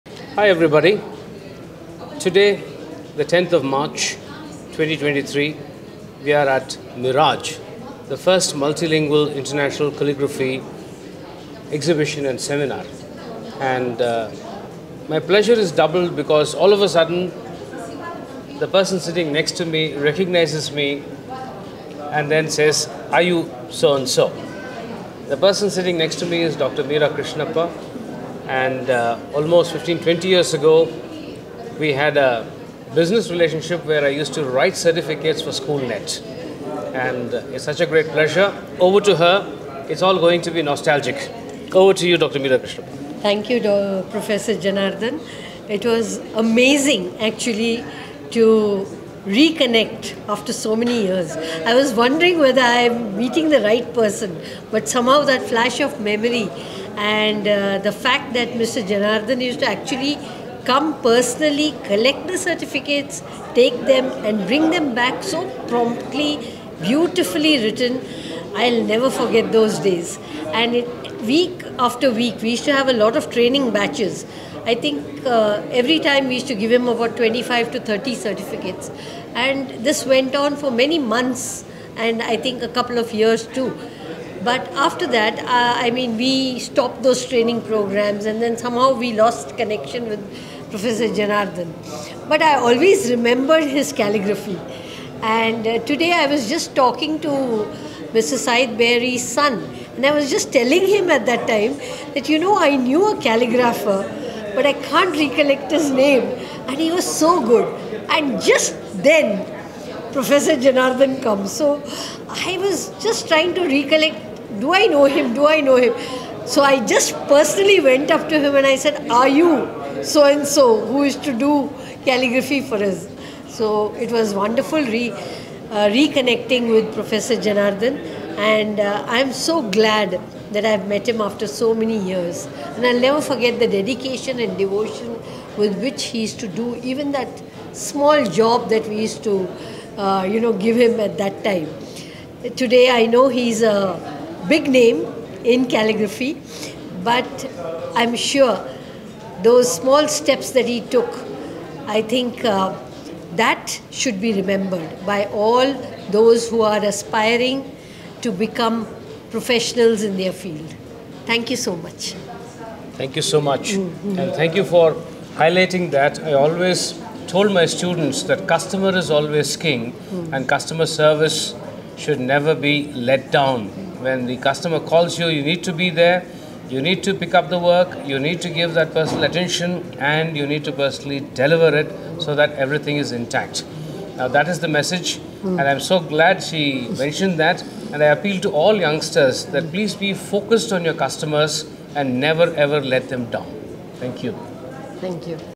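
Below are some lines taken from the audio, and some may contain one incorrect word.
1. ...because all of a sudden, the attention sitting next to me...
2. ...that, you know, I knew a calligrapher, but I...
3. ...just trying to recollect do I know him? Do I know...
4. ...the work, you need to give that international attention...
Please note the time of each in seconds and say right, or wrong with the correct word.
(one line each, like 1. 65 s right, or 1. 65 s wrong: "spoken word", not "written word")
1. 16 s wrong: "person", not "attention"
2. 102 s right
3. 113 s right
4. 177 s wrong: "personal", not "international".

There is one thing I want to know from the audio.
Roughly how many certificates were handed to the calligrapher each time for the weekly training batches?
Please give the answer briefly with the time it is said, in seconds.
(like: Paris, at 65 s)
25 to 30, at 77 s.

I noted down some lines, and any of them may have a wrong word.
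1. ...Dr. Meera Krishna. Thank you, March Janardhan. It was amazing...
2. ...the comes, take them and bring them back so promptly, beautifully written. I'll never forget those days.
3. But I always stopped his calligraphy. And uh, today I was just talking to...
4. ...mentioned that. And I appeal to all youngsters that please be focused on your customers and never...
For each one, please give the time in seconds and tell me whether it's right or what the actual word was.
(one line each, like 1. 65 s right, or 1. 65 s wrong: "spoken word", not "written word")
1. 42 s wrong: "Professor", not "March"
2. 62 s wrong: "certificates", not "comes"
3. 92 s wrong: "remembered", not "stopped"
4. 186 s right.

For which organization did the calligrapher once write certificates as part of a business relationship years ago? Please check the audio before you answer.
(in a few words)
SchoolNet.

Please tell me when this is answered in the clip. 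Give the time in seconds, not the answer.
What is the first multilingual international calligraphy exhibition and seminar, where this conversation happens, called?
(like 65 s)
6 s.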